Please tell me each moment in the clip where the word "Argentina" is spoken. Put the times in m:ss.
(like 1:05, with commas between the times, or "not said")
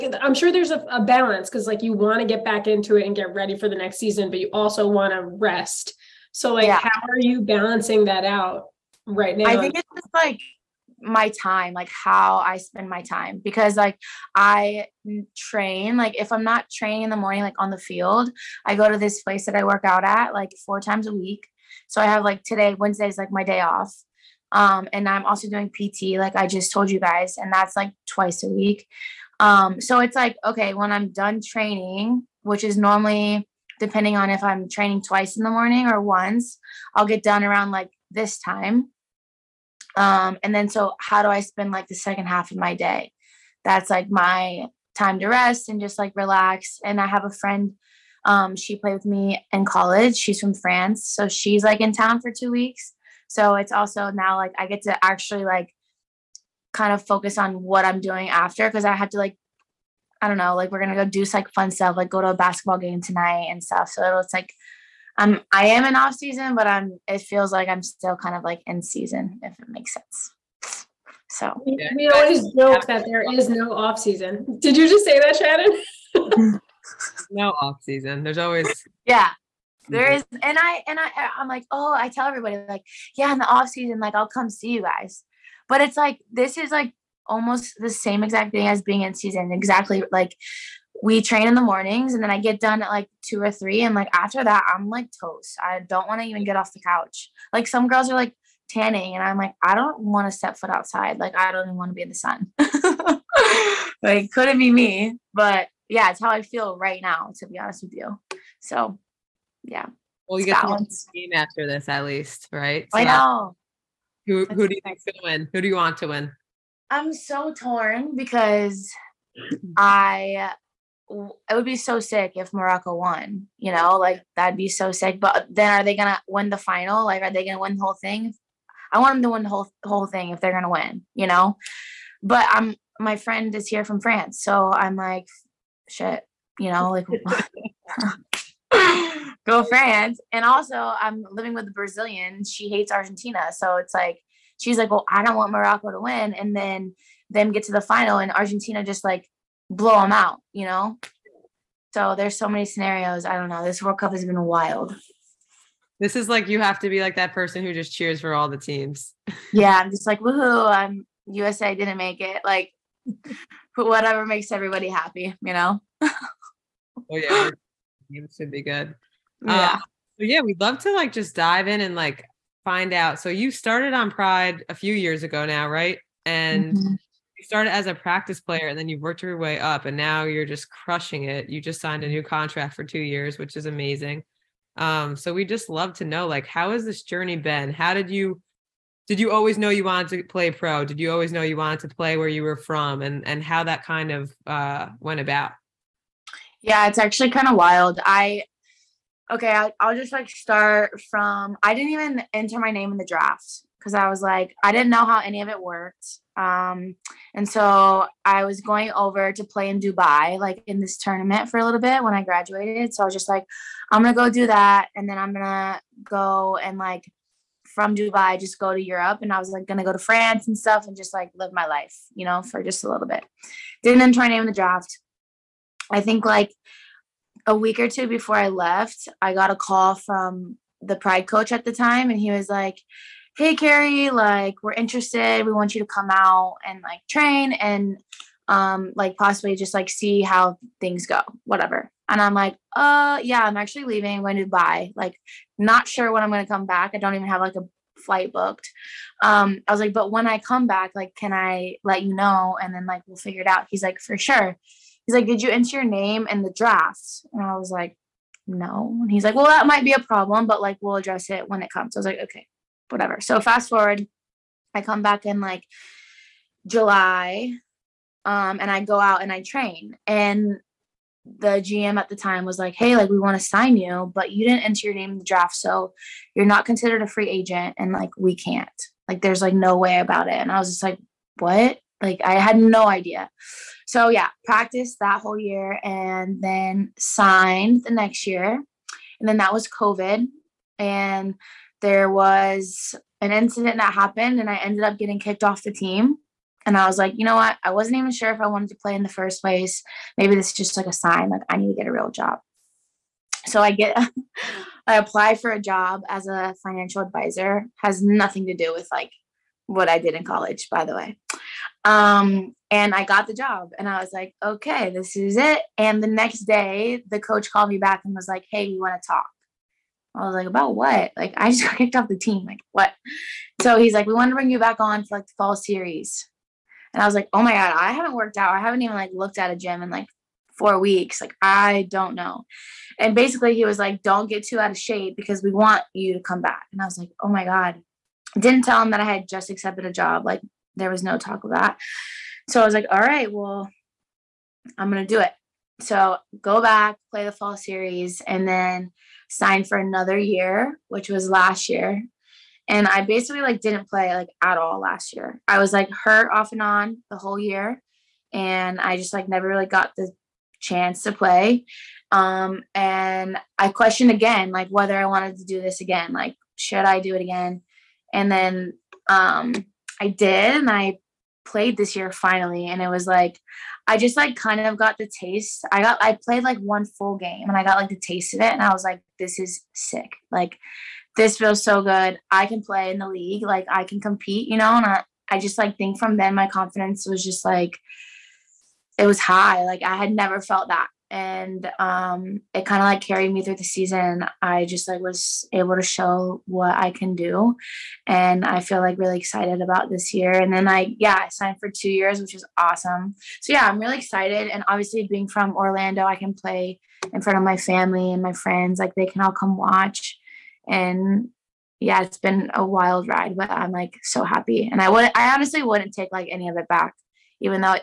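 2:22, 2:28.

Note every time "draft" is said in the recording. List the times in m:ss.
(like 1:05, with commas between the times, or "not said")
3:23, 3:44, 4:16, 4:35.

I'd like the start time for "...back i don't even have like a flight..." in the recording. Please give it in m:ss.
4:06.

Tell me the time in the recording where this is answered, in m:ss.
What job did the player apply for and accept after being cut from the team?
5:06.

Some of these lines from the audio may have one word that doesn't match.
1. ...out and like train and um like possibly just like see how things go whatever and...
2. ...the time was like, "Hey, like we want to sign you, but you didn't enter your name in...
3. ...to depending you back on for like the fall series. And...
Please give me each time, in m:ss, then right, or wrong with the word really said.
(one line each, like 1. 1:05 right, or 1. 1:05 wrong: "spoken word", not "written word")
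1. 3:56 right
2. 4:32 right
3. 5:24 wrong: "bring", not "depending".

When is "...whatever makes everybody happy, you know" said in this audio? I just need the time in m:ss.
2:43.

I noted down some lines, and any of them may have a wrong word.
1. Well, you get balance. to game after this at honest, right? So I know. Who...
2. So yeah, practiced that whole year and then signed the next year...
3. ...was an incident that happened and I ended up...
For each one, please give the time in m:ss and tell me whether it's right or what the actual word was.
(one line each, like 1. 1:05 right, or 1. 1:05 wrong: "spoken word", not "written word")
1. 1:50 wrong: "least", not "honest"
2. 4:43 right
3. 4:52 right.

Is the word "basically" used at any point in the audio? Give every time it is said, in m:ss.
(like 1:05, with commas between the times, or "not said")
5:33, 5:53.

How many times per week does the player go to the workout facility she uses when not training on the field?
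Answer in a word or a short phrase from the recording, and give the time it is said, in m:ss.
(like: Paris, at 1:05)
4 times a week, at 0:20.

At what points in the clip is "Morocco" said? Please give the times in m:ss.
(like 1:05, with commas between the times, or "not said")
2:02, 2:25.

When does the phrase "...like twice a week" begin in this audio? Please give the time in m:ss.
0:27.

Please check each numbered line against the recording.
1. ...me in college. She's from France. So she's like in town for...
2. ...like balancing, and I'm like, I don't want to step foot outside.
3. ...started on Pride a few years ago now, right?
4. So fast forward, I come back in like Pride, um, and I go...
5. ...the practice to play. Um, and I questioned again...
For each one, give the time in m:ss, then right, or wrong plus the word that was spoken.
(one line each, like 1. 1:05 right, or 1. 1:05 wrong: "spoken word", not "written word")
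1. 0:49 right
2. 1:38 wrong: "tanning", not "balancing"
3. 2:53 right
4. 4:23 wrong: "July", not "Pride"
5. 5:59 wrong: "chance", not "practice".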